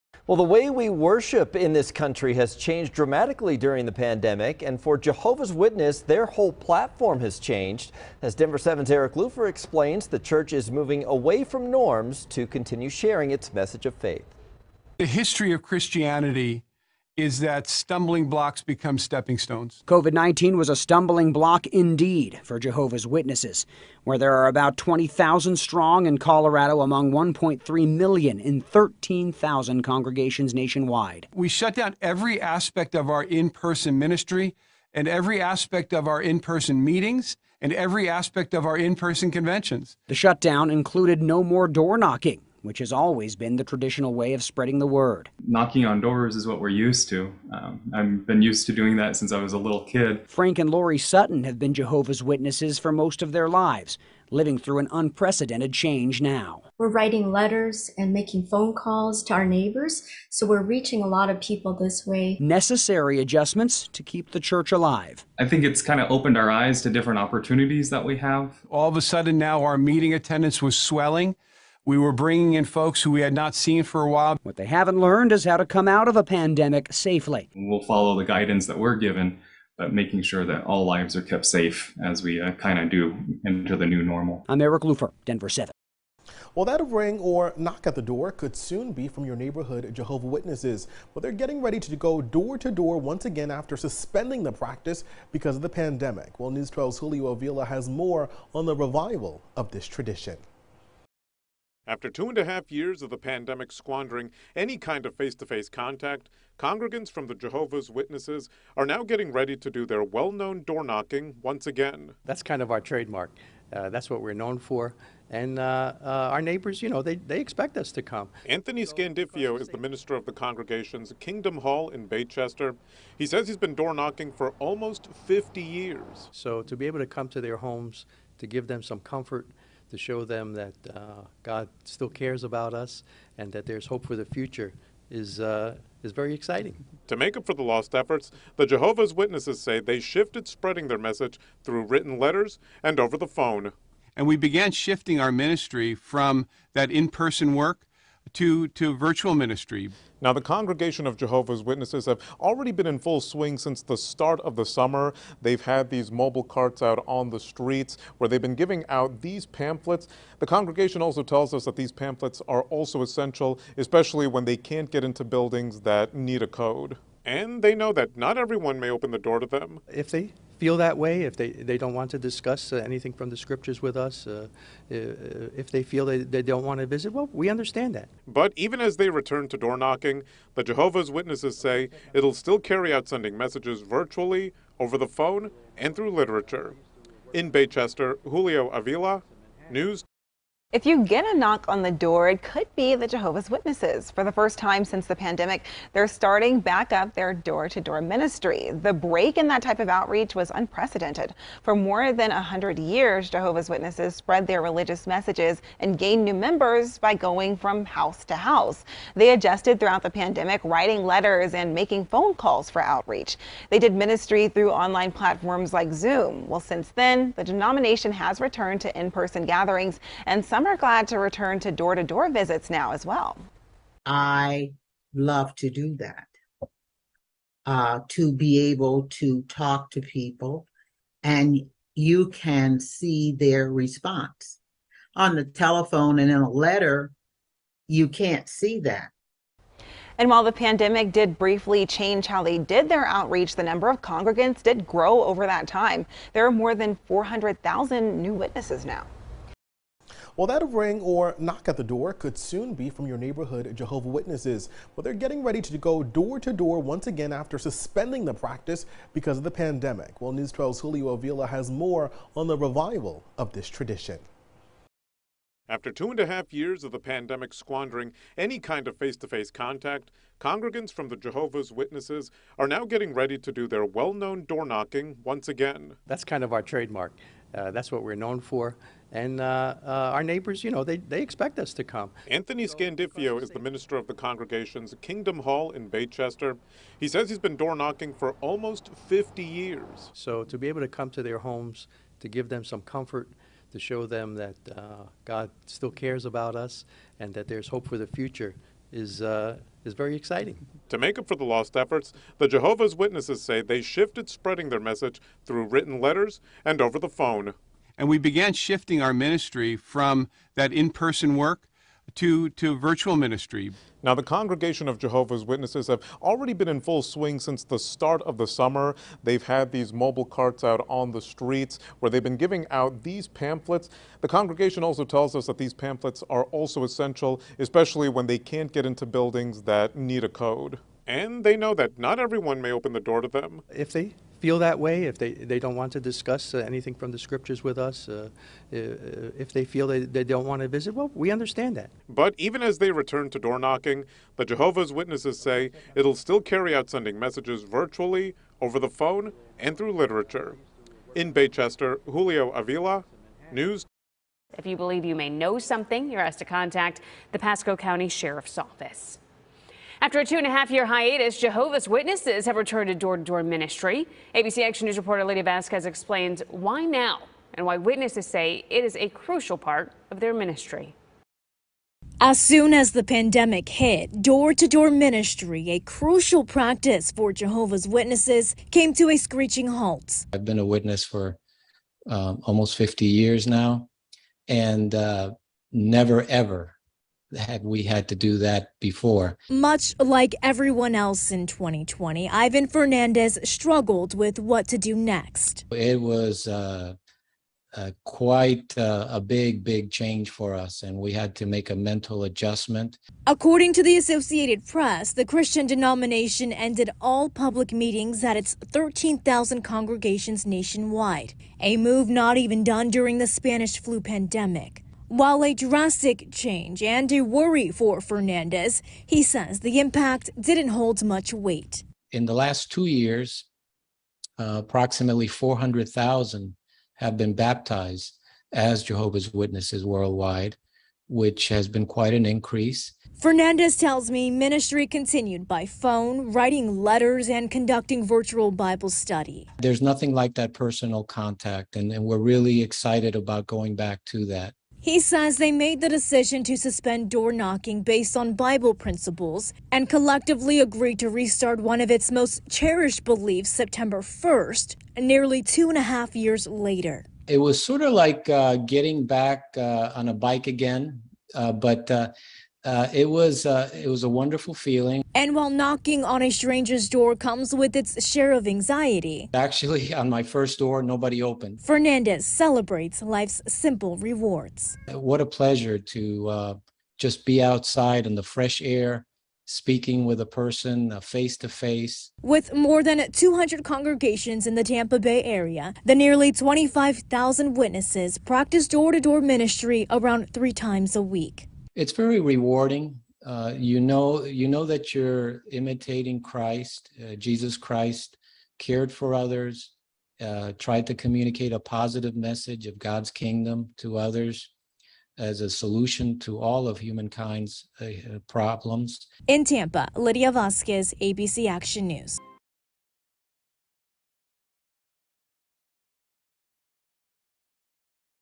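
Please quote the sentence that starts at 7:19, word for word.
There's nothing like that personal contact, and, and we're really excited about going back to that.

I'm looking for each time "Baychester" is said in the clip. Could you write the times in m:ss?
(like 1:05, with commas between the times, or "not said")
2:02, 3:07, 4:45, 5:51.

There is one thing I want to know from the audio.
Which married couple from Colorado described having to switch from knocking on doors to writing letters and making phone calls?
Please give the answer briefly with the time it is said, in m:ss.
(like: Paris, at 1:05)
Frank and Lori Sutton, at 0:50.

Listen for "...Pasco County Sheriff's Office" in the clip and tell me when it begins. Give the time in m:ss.
5:57.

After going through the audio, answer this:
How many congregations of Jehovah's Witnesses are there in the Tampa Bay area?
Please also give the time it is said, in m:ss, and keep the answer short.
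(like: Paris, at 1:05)
More than 200, at 8:02.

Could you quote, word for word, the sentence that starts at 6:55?
While a drastic change and a worry for Fernandez, he says the impact didn't hold much weight.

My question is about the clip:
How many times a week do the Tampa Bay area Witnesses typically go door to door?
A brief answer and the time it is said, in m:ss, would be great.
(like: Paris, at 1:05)
3, at 8:10.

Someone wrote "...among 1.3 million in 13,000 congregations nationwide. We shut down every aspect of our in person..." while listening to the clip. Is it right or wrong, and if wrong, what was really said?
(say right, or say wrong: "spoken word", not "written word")
right.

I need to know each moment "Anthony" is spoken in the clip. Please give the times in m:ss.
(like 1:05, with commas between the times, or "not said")
1:58, 4:42.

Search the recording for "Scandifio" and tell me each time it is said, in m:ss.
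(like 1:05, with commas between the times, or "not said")
1:58, 4:42.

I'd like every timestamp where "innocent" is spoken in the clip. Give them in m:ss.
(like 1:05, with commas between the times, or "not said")
not said.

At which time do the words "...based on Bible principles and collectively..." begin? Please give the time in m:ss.
7:27.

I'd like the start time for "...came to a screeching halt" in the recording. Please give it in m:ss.
6:18.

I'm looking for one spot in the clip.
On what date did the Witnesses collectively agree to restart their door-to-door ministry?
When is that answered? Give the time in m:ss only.
7:33.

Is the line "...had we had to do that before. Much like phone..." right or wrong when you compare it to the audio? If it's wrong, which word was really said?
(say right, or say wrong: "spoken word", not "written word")
wrong: "everyone", not "phone".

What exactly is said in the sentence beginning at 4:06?
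There are more than 400,000 new witnesses now.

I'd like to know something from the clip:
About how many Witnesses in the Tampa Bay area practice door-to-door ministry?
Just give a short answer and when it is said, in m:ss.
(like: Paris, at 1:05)
Nearly 25,000, at 8:05.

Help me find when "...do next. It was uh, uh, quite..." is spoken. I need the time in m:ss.
6:34.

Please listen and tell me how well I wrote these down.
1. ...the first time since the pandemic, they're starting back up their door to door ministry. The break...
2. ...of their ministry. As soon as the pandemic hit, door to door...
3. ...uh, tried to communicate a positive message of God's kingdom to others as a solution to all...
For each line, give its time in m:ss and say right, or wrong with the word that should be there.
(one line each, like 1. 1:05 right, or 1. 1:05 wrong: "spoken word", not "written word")
1. 3:14 right
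2. 6:10 right
3. 8:20 right.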